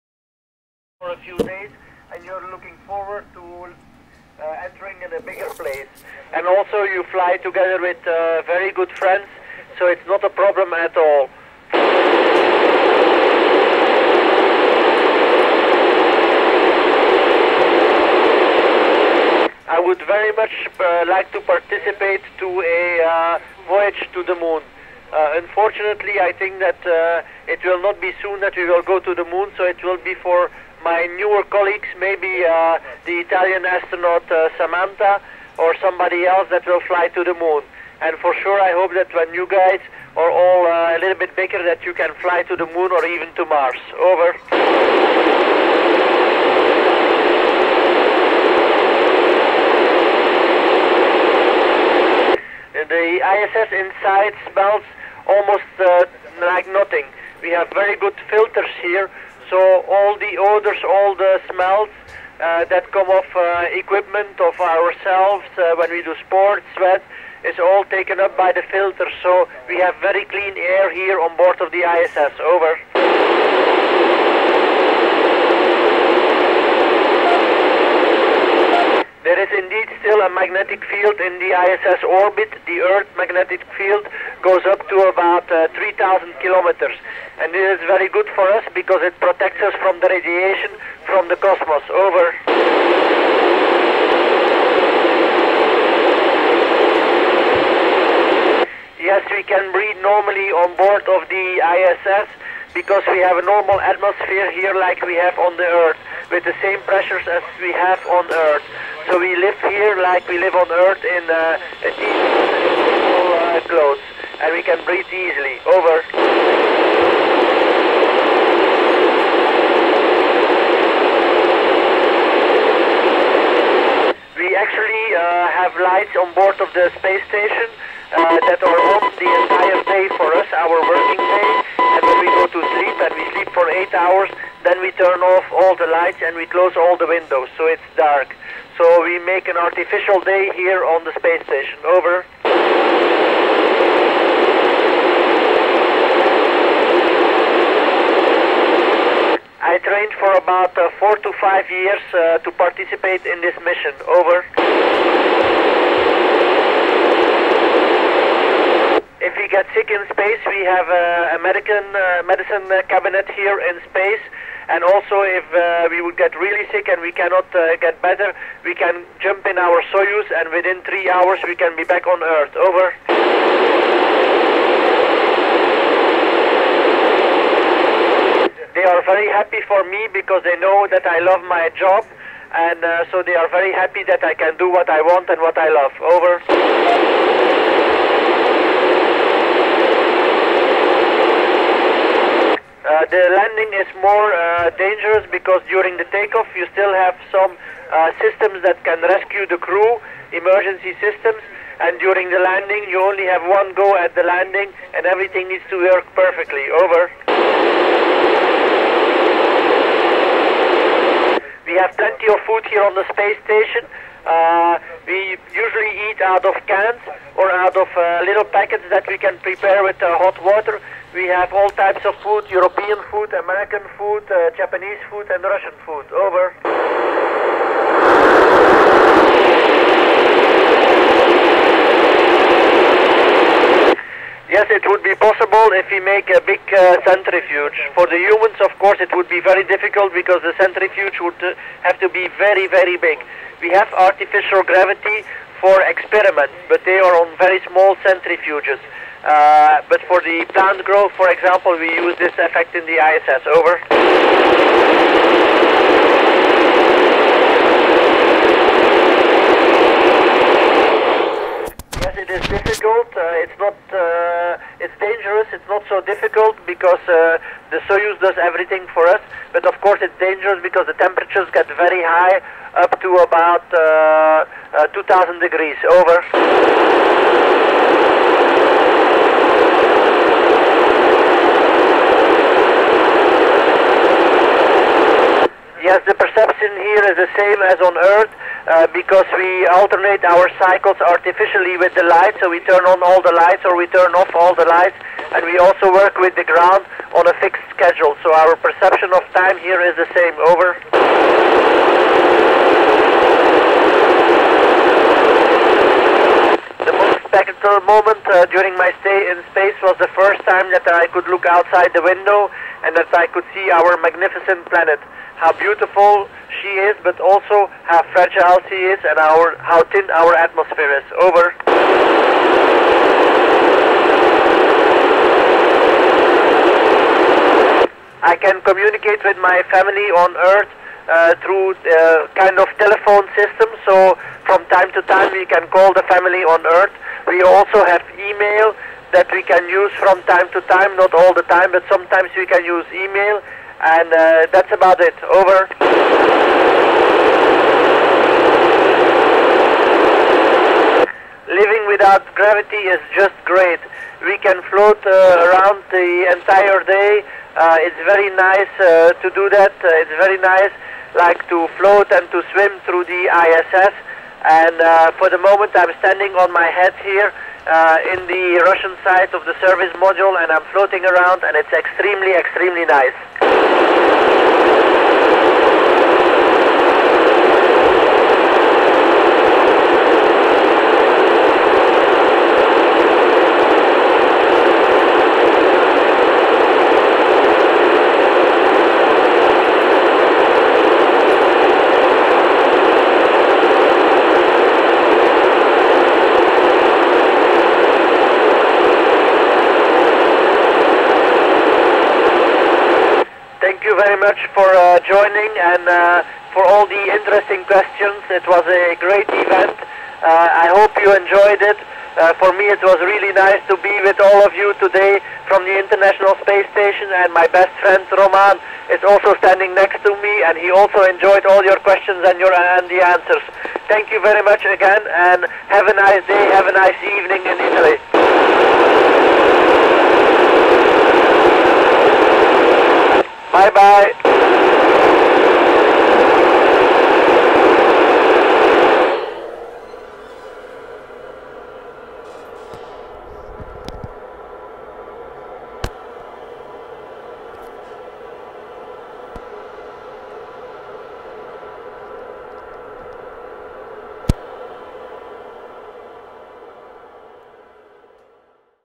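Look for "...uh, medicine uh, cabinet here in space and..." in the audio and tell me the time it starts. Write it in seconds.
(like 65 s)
161 s.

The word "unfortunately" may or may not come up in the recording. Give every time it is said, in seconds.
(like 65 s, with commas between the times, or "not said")
25 s.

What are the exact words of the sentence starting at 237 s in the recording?
For the humans, of course, it would be very difficult because the centrifuge would uh, have to be very, very big.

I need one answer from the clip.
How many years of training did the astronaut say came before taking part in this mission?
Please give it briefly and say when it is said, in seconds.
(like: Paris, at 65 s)
4 to 5 years, at 150 s.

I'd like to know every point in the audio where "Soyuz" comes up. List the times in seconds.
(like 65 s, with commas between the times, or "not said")
169 s, 267 s.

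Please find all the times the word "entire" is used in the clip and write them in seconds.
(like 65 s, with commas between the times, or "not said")
129 s, 356 s.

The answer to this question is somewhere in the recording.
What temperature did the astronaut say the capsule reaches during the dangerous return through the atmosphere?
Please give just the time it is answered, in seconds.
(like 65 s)
274 s.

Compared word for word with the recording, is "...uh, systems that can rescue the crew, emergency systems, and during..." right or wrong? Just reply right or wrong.
right.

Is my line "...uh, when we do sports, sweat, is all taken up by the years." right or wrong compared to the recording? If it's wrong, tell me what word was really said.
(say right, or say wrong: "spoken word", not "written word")
wrong: "filters", not "years".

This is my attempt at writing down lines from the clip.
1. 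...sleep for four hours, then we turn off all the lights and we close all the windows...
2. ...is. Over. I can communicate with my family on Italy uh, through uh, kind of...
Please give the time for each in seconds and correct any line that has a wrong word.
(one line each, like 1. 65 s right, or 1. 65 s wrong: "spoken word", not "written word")
1. 133 s wrong: "eight", not "four"
2. 321 s wrong: "Earth", not "Italy".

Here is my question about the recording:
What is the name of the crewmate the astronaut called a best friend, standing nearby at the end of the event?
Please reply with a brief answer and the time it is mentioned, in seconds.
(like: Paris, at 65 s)
Roman, at 418 s.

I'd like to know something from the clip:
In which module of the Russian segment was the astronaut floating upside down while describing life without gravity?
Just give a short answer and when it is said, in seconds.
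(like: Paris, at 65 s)
service module, at 369 s.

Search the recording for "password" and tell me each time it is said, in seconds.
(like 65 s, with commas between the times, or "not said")
not said.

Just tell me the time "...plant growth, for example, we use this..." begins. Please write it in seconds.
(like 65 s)
250 s.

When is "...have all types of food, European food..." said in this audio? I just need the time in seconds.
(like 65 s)
221 s.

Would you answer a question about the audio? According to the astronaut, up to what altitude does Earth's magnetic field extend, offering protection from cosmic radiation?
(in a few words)
3,000 kilometers.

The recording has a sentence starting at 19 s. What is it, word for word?
I would very much uh, like to participate to a uh, voyage to the moon.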